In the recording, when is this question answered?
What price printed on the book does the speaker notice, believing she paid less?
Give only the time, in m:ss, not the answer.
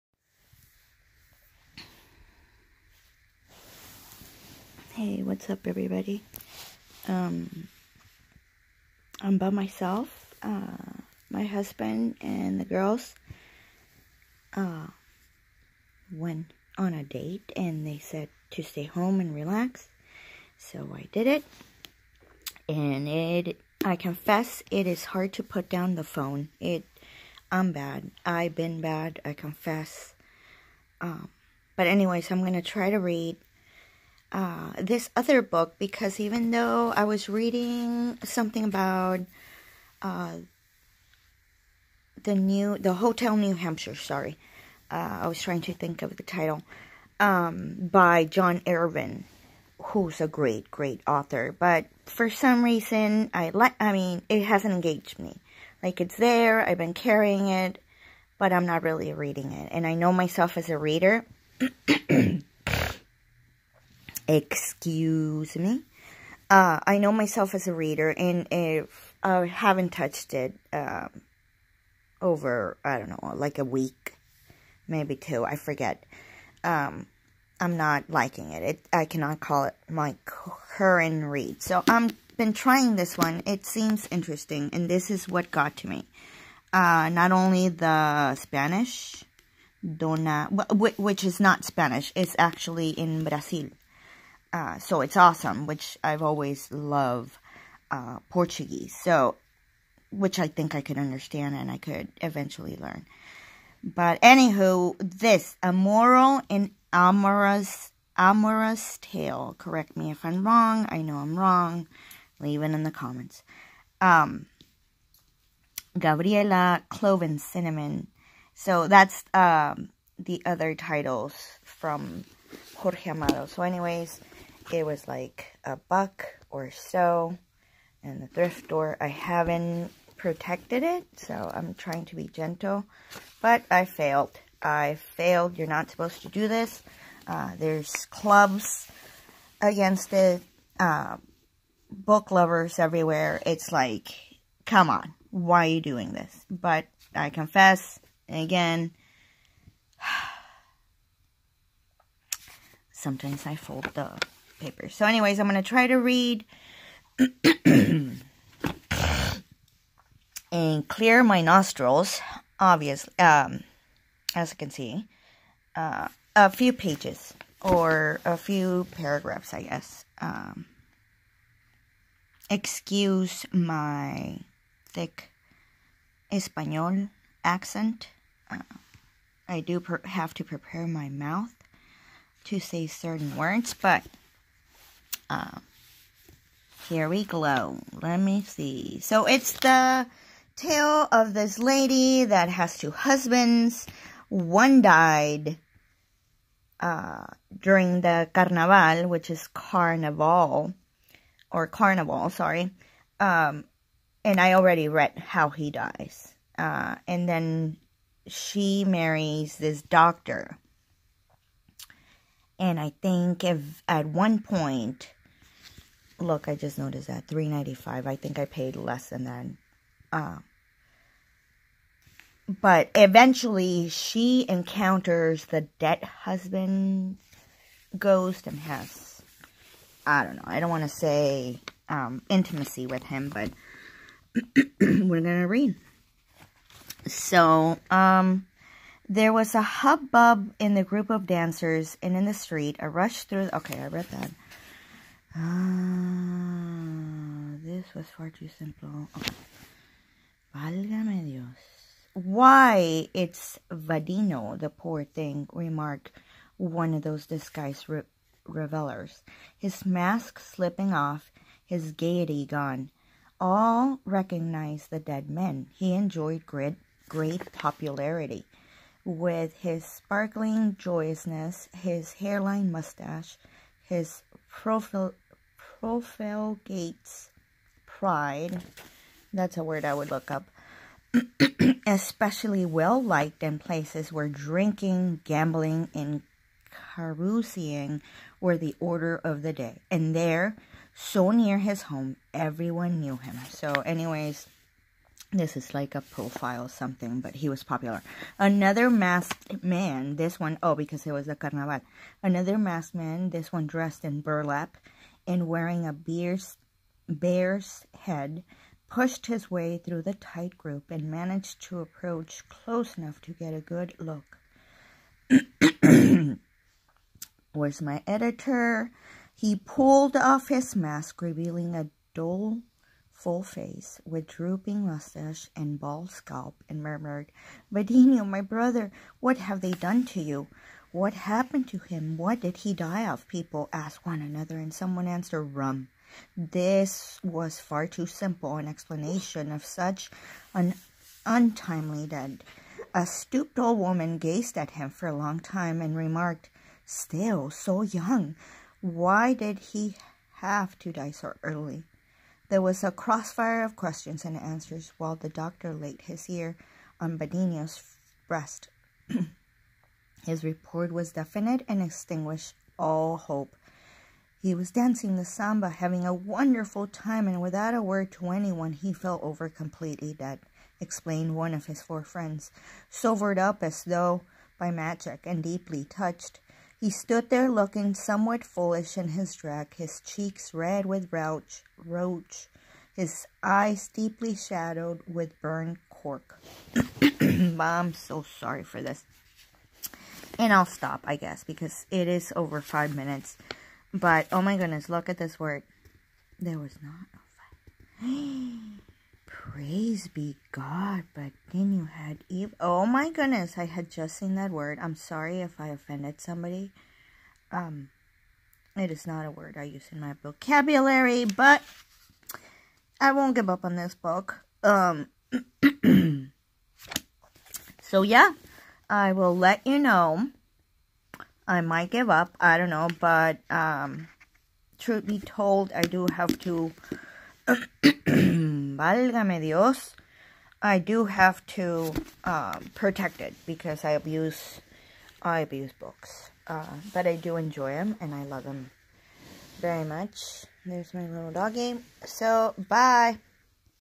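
3:37.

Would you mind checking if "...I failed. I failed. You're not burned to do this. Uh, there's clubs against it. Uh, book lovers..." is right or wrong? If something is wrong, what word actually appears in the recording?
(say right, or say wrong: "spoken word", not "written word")
wrong: "supposed", not "burned".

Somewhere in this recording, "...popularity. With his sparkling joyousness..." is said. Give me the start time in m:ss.
4:27.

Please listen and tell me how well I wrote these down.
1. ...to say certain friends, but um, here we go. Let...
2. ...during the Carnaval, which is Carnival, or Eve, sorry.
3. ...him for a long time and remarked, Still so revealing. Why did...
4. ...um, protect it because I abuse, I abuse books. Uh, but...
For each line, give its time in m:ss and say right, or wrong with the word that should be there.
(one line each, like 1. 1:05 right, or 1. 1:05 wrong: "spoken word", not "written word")
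1. 3:02 wrong: "words", not "friends"
2. 3:17 wrong: "Carnival", not "Eve"
3. 5:44 wrong: "young", not "revealing"
4. 7:12 right.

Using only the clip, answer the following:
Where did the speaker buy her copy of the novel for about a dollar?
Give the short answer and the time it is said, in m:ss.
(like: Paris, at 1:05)
the thrift store, at 2:08.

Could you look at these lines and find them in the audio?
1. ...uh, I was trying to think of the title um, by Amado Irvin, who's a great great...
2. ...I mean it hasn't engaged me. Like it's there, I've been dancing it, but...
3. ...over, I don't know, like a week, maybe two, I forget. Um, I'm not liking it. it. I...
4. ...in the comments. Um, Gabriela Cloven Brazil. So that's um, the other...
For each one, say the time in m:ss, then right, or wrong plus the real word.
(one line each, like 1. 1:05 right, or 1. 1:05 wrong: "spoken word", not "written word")
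1. 0:44 wrong: "John", not "Amado"
2. 0:53 wrong: "carrying", not "dancing"
3. 1:12 right
4. 1:52 wrong: "Cinnamon", not "Brazil".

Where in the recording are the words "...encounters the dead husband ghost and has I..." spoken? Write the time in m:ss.
3:44.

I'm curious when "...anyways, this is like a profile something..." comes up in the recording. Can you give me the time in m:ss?
4:53.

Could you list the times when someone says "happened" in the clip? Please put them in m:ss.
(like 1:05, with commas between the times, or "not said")
5:31.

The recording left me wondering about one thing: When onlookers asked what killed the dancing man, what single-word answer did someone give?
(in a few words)
Rum.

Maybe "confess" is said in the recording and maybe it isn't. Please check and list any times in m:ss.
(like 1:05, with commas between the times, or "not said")
0:23, 0:29, 2:27.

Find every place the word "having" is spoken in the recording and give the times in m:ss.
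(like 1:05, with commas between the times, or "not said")
6:05.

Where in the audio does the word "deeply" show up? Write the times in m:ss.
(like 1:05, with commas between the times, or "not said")
6:15, 6:23.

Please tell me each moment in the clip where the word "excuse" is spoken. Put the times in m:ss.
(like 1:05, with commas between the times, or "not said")
1:04, 2:52.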